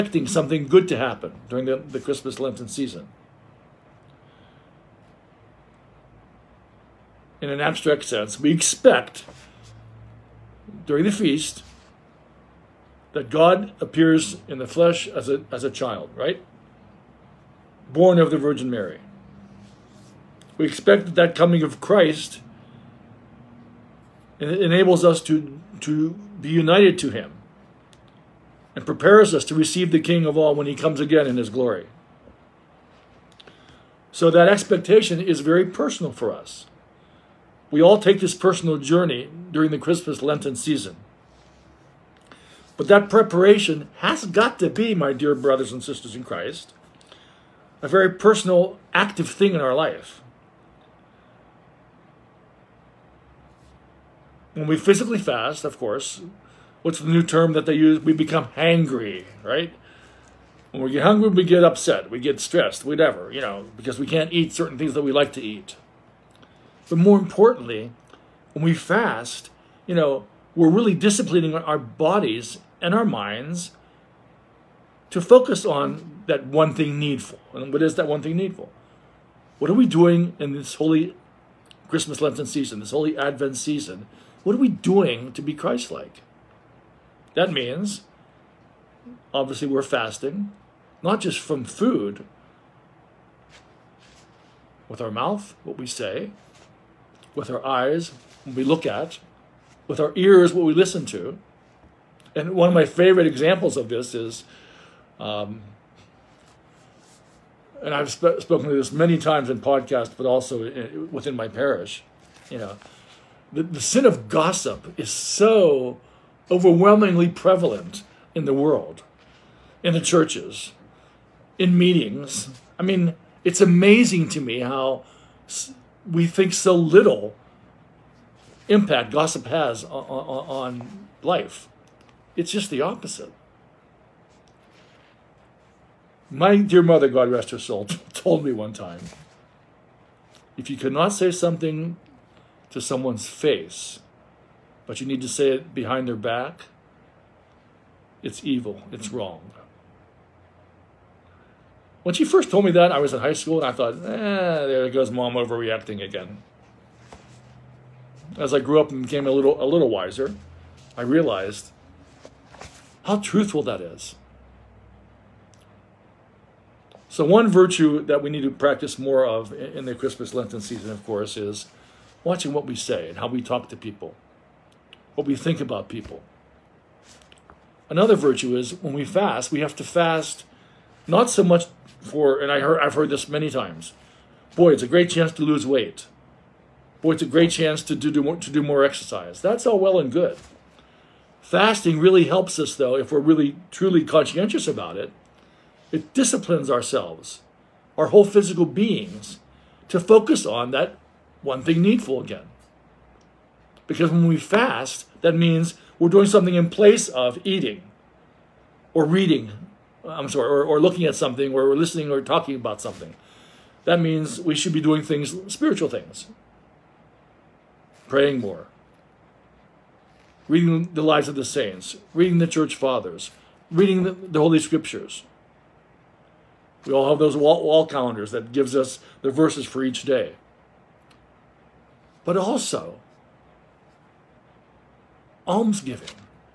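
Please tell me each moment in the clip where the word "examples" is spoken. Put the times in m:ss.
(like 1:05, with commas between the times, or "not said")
1:43.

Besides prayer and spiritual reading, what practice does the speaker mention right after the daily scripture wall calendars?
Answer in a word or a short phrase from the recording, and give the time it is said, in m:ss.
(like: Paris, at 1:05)
almsgiving, at 3:55.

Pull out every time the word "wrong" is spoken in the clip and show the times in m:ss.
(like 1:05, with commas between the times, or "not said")
2:29.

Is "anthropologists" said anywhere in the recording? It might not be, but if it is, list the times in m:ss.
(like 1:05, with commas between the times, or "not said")
not said.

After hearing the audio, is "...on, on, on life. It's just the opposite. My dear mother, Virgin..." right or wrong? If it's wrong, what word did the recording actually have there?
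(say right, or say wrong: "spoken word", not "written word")
wrong: "God", not "Virgin".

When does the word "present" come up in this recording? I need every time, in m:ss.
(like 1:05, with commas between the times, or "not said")
not said.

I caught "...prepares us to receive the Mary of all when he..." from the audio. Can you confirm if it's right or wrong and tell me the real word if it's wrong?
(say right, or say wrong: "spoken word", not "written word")
wrong: "King", not "Mary".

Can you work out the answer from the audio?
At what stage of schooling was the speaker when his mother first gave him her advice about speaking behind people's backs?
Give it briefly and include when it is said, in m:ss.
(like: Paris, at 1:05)
high school, at 2:33.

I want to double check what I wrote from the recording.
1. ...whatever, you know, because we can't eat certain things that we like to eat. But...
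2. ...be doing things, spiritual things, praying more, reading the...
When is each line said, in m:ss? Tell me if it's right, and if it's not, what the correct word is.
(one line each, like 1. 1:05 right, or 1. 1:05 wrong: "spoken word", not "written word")
1. 1:02 right
2. 3:34 right.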